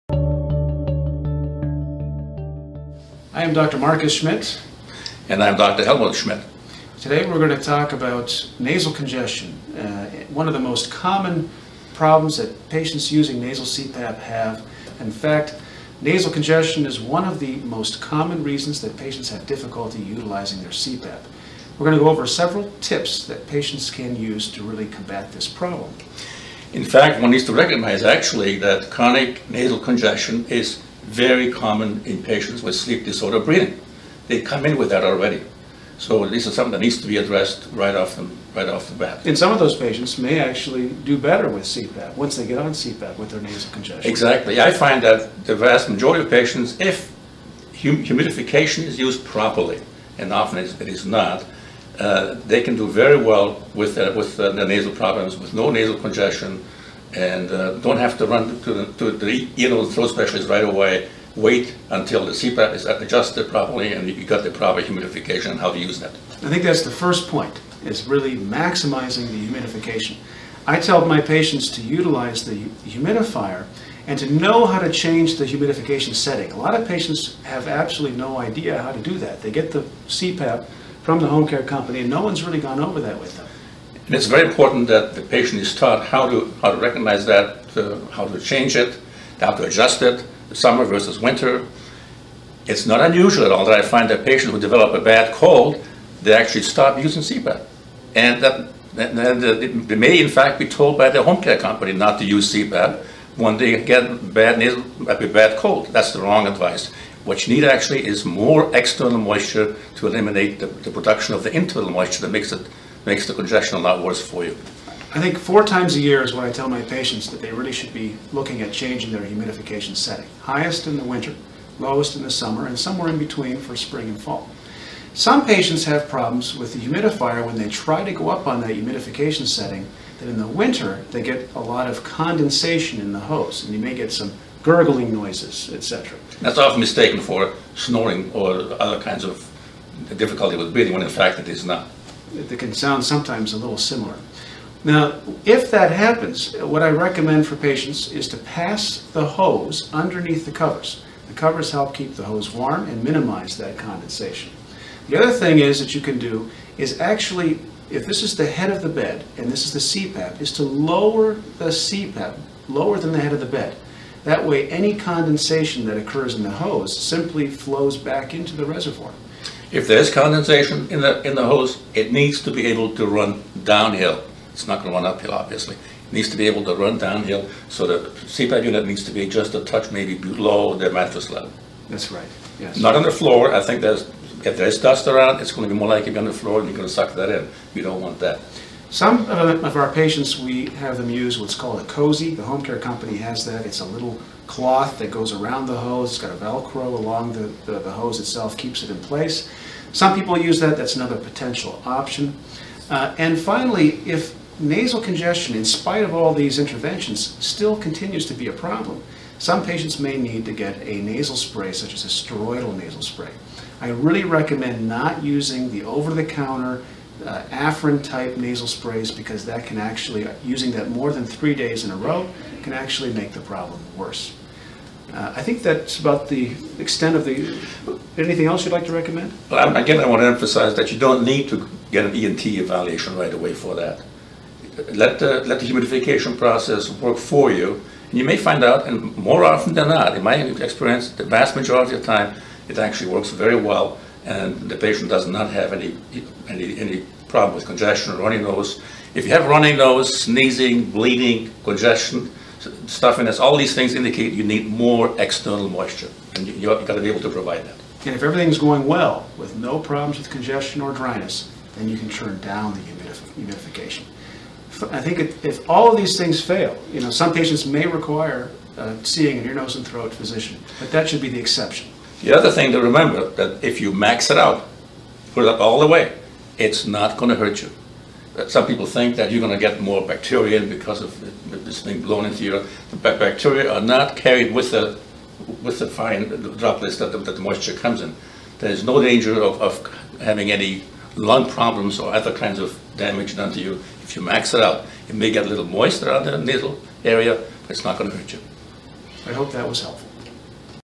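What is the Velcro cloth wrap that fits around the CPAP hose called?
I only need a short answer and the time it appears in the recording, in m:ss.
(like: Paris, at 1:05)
cozy, at 3:11.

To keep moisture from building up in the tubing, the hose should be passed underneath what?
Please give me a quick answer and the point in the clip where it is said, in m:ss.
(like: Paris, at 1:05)
the covers, at 2:29.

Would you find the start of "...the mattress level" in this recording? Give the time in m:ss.
3:00.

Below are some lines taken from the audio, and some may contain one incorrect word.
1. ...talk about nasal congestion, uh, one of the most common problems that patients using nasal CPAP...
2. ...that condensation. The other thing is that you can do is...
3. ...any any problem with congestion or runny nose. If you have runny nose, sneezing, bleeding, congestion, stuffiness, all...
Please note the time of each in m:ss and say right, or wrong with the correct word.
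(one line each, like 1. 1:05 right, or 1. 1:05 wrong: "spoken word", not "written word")
1. 0:07 right
2. 2:33 right
3. 4:06 right.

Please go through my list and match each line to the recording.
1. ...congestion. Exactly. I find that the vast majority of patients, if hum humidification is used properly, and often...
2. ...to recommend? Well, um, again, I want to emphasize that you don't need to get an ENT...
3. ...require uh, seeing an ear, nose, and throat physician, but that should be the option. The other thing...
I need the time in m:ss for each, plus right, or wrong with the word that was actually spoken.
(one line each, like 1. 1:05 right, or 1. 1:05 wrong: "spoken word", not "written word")
1. 0:43 right
2. 3:48 right
3. 4:27 wrong: "exception", not "option".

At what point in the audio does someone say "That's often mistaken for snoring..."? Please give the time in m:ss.
2:16.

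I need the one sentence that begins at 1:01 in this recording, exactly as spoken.
Wait until the CPAP is adjusted properly and you got the proper humidification and how to use that.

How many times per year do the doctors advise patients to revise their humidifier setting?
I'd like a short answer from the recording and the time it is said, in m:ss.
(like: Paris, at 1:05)
4, at 1:55.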